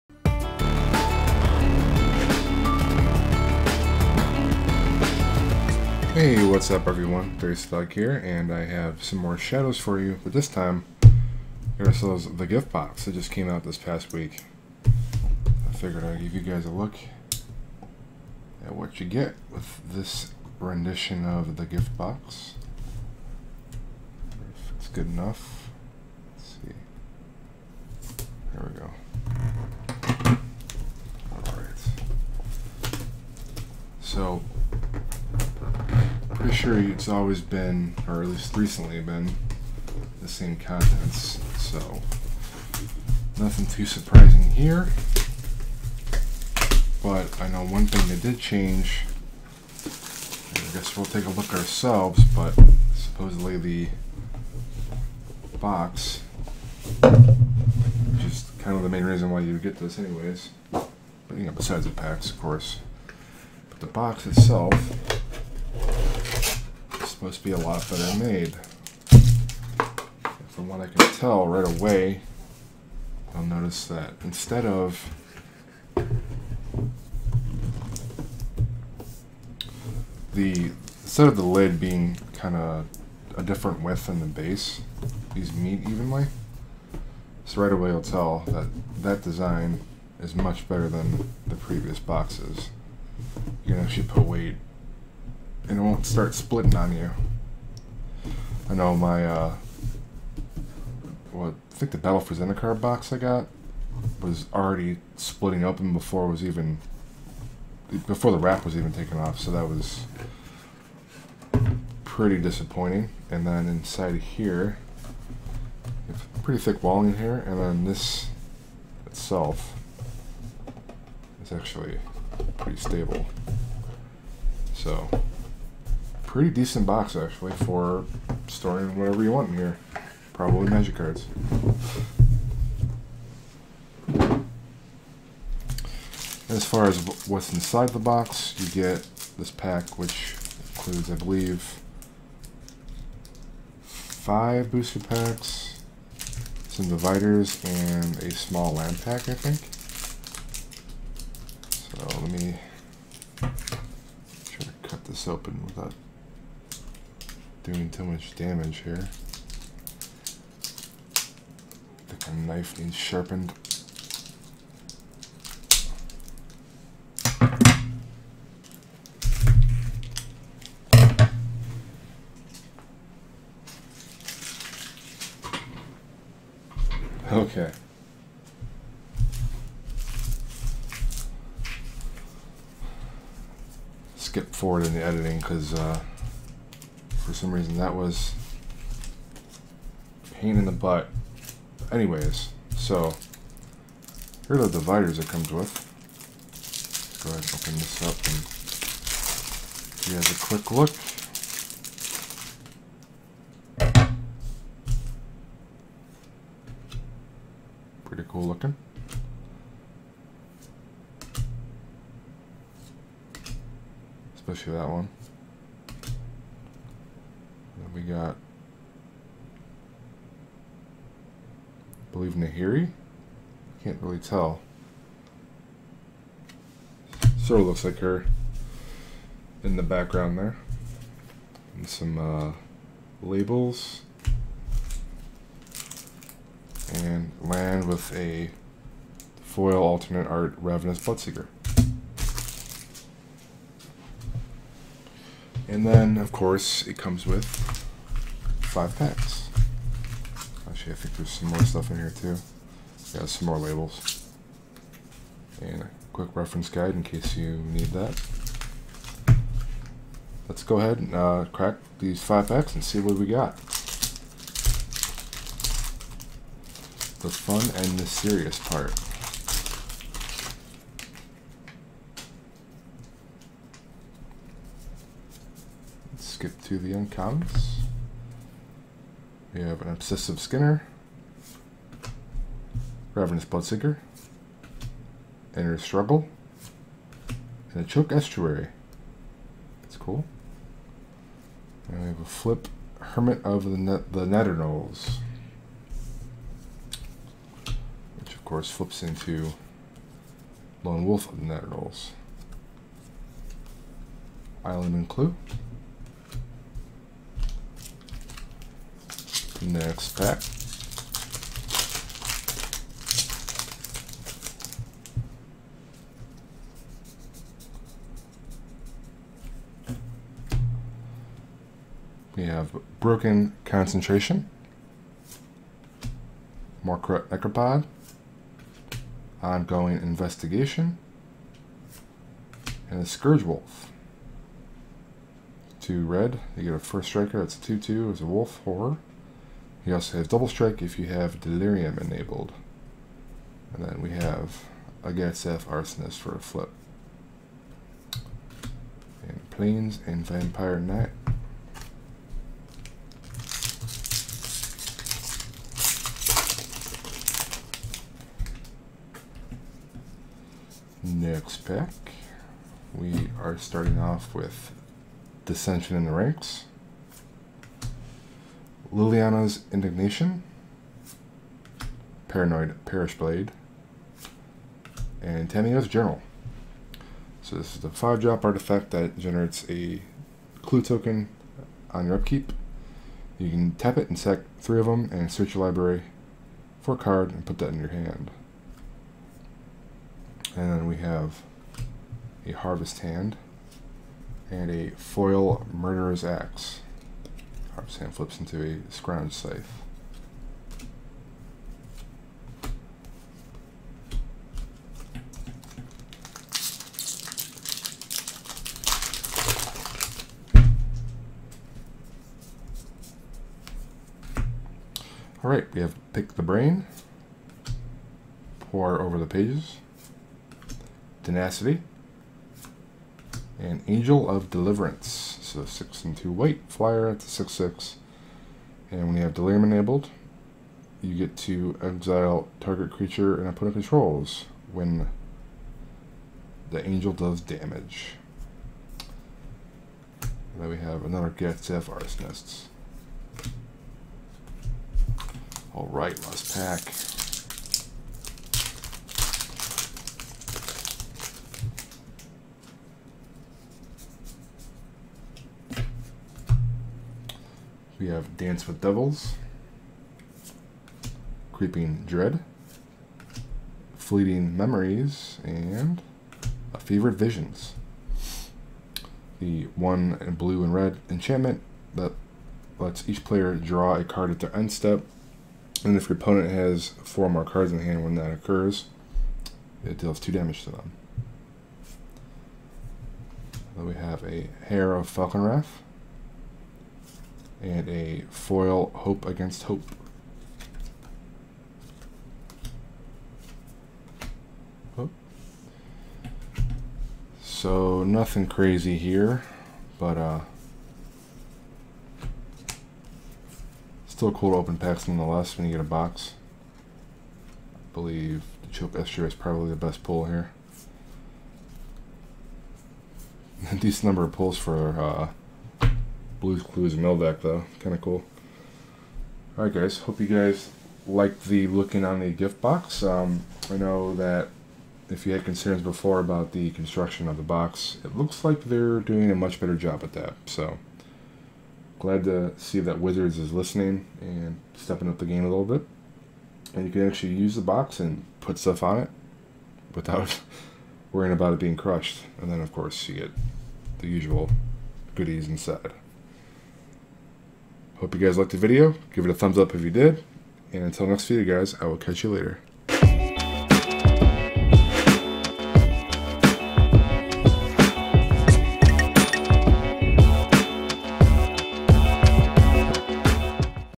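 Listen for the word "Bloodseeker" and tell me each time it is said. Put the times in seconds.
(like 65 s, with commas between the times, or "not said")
241 s, 283 s.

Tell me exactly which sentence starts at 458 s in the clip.
We have Dance with Devils, Creeping Dread, Fleeting Memories, and a Fevered Visions.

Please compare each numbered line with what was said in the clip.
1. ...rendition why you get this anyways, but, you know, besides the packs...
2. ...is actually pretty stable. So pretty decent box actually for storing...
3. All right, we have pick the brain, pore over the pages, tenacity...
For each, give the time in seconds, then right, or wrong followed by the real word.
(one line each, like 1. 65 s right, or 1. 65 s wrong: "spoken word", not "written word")
1. 59 s wrong: "reason", not "rendition"
2. 121 s right
3. 415 s right.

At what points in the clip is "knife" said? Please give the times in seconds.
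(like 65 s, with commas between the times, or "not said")
162 s.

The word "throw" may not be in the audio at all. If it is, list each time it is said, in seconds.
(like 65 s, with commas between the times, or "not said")
not said.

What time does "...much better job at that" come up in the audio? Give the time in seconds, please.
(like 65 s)
529 s.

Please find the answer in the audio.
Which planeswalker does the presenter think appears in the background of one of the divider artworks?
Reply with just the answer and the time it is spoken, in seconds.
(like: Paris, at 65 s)
Nahiri, at 222 s.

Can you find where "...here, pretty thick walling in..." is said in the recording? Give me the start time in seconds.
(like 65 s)
114 s.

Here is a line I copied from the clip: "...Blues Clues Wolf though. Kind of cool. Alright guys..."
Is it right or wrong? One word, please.
wrong.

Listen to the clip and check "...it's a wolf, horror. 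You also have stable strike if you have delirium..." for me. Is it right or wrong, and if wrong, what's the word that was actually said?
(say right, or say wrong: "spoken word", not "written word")
wrong: "double", not "stable".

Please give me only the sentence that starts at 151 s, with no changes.
So let me try to cut this open without doing too much damage here.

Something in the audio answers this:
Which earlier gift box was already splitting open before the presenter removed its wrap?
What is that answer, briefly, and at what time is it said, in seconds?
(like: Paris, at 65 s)
Battle for Zendikar, at 101 s.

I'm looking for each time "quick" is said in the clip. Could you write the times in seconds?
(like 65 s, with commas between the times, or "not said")
200 s, 256 s.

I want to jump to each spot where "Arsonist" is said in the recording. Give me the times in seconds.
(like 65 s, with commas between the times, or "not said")
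345 s, 441 s.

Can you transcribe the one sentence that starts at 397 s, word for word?
Sam flips into a scrounged scythe.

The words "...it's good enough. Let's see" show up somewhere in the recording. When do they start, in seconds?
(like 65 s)
24 s.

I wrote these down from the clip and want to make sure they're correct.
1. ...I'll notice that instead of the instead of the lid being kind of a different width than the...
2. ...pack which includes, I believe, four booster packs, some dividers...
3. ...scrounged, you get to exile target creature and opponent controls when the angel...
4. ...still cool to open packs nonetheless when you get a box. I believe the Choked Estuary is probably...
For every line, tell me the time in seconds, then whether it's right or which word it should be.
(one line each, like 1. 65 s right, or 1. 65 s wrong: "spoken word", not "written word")
1. 73 s right
2. 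139 s wrong: "five", not "four"
3. 429 s wrong: "enabled", not "scrounged"
4. 504 s right.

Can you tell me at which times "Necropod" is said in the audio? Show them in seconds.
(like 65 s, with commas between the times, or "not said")
327 s.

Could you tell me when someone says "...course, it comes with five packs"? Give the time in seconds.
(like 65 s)
246 s.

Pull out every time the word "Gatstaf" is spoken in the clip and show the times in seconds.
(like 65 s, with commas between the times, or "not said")
345 s, 441 s.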